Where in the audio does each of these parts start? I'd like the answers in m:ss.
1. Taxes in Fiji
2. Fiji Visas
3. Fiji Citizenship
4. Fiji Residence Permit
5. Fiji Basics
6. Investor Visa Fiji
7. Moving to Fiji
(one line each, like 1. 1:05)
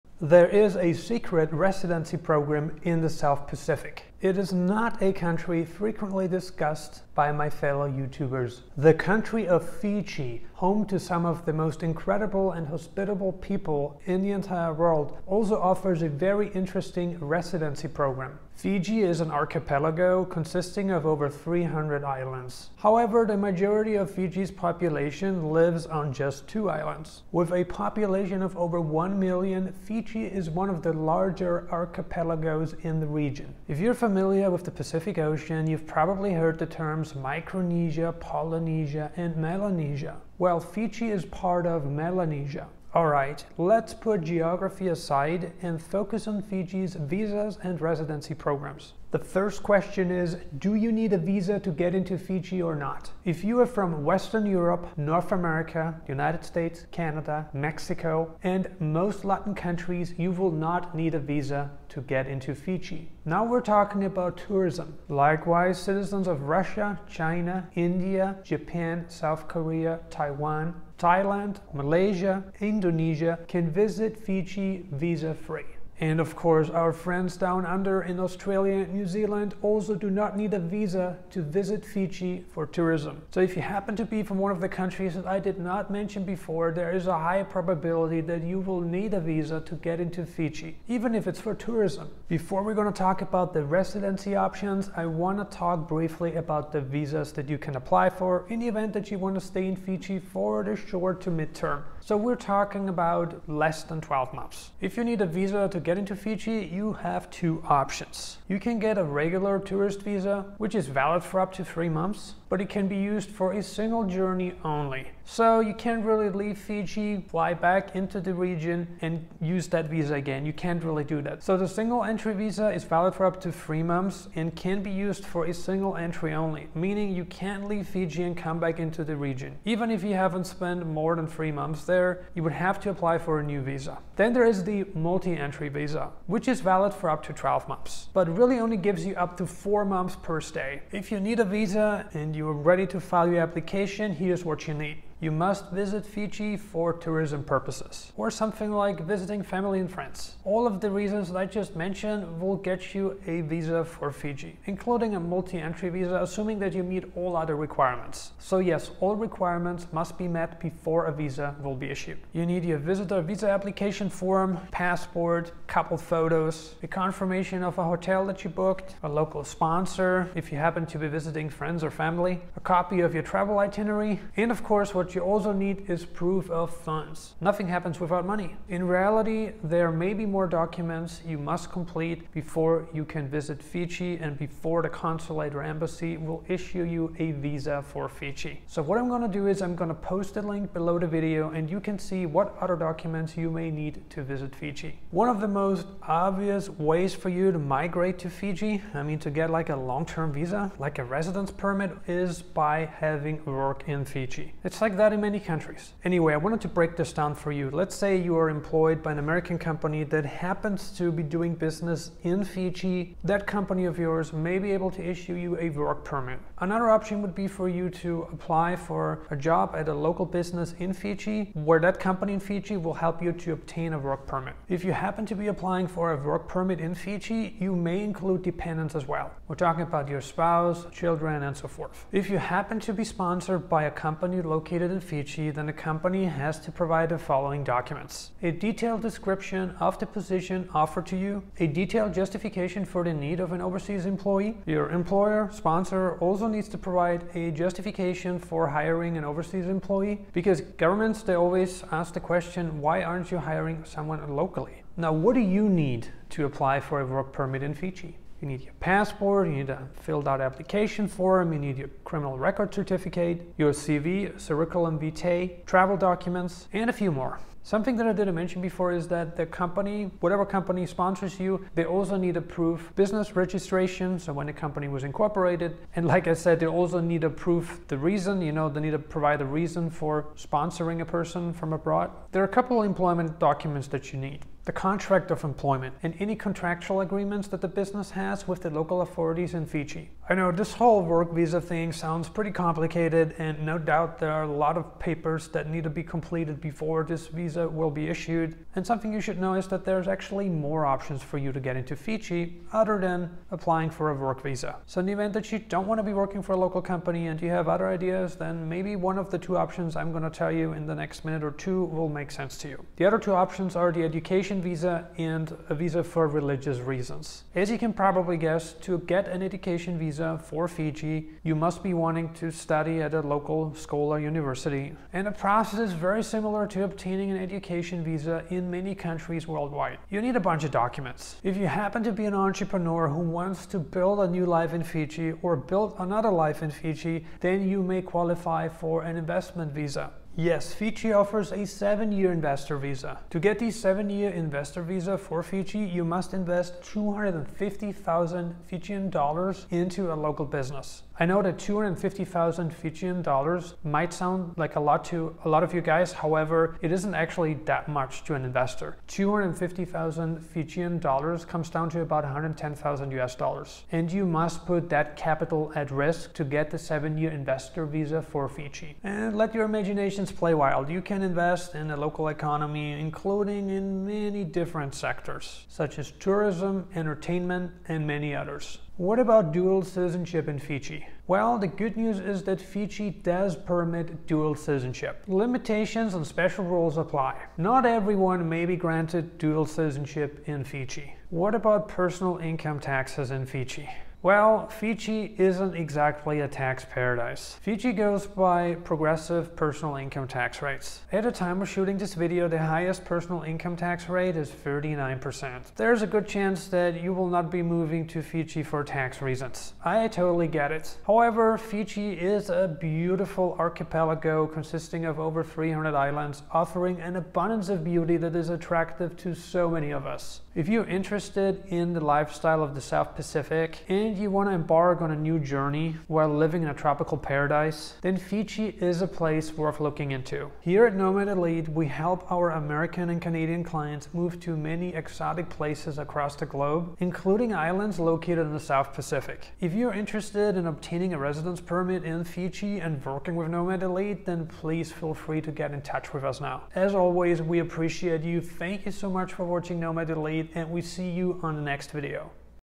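1. 6:30
2. 0:42
3. 6:18
4. 3:15
5. 0:10
6. 5:31
7. 6:50.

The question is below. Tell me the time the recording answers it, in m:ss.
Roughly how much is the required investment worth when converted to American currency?
6:02.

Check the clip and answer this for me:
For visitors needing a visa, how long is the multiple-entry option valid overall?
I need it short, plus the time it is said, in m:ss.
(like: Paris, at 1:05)
12 months, at 2:16.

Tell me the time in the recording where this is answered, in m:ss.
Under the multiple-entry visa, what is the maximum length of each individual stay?
2:19.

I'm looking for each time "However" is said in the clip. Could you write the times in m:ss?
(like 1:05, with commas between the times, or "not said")
0:22, 5:56, 6:51.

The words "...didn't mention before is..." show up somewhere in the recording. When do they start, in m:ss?
4:28.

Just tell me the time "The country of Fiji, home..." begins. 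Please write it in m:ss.
0:08.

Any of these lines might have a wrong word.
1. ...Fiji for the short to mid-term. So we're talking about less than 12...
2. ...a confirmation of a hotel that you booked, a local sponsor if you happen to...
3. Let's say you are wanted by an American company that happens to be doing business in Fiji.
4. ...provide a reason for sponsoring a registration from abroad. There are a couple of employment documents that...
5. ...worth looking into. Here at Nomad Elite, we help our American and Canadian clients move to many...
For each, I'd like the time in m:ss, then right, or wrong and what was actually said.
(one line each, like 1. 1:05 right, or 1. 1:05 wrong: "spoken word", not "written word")
1. 1:39 right
2. 2:46 right
3. 3:27 wrong: "employed", not "wanted"
4. 4:38 wrong: "person", not "registration"
5. 7:09 right.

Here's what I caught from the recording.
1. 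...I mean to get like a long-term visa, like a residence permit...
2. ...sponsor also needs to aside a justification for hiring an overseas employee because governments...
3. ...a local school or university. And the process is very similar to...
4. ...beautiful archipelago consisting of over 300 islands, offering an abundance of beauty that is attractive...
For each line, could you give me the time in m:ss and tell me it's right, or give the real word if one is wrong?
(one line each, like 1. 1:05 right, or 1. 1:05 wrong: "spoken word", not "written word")
1. 3:18 right
2. 4:05 wrong: "provide", not "aside"
3. 5:23 right
4. 6:52 right.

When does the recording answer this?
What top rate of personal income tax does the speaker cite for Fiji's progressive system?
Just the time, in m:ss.
6:44.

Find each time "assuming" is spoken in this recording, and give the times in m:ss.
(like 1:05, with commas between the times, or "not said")
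2:36.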